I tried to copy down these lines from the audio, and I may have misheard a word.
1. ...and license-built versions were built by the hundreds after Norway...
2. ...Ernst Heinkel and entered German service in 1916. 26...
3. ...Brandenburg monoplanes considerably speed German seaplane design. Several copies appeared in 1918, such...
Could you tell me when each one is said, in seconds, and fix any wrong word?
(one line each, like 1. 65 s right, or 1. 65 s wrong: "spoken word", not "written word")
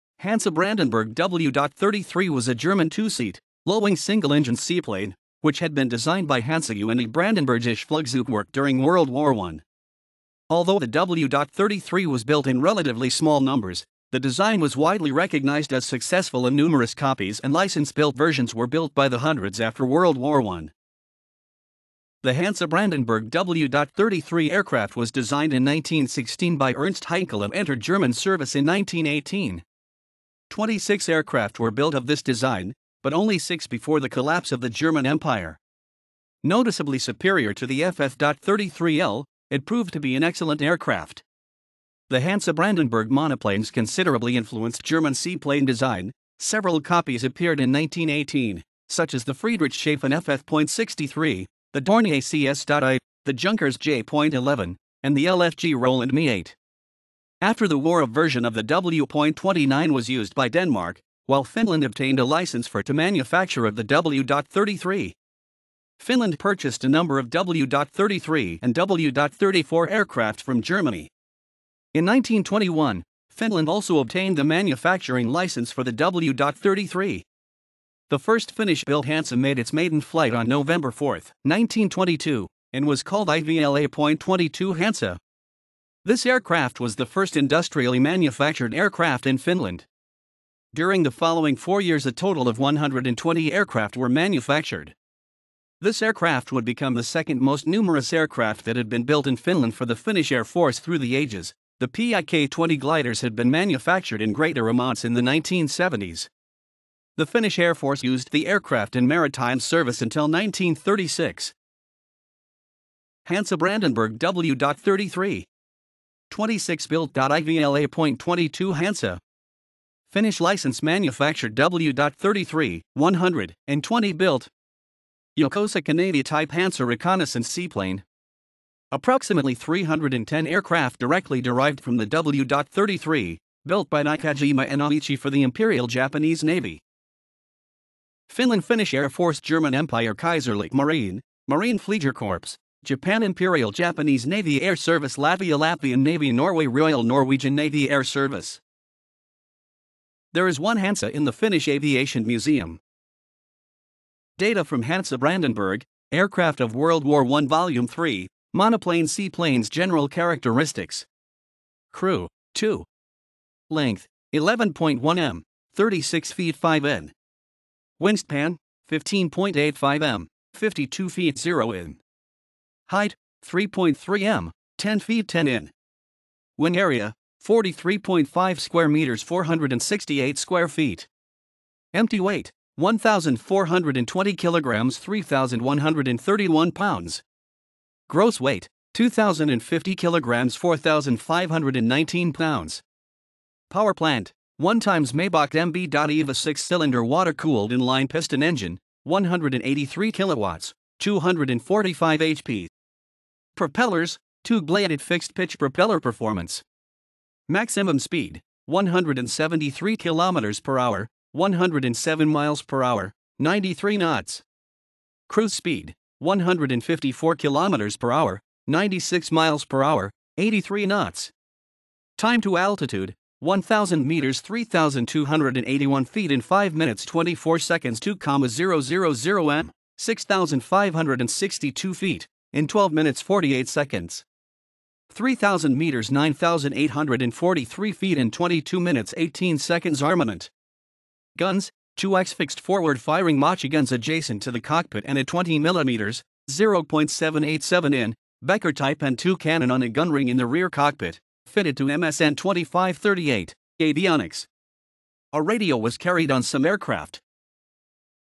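1. 17 s wrong: "World", not "Norway"
2. 26 s wrong: "1918", not "1916"
3. 42 s wrong: "influenced", not "speed".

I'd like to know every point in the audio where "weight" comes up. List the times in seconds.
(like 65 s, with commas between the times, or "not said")
182 s, 188 s.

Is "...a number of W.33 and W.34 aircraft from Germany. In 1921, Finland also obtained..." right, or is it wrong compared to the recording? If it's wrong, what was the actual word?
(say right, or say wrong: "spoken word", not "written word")
right.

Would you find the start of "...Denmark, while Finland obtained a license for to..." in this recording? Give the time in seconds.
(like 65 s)
60 s.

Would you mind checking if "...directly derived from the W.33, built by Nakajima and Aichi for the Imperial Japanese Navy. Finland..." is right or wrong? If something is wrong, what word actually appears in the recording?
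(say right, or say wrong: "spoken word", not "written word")
right.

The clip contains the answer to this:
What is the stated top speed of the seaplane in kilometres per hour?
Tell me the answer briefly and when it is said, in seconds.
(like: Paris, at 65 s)
173, at 208 s.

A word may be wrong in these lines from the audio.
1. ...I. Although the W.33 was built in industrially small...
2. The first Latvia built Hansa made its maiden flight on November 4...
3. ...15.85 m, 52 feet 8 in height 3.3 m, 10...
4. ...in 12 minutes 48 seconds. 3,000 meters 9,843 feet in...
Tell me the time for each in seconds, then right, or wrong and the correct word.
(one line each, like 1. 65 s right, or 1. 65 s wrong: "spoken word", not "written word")
1. 9 s wrong: "relatively", not "industrially"
2. 78 s wrong: "Finnish", not "Latvia"
3. 168 s wrong: "0", not "8"
4. 232 s right.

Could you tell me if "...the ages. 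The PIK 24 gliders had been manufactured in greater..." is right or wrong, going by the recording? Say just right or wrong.
wrong.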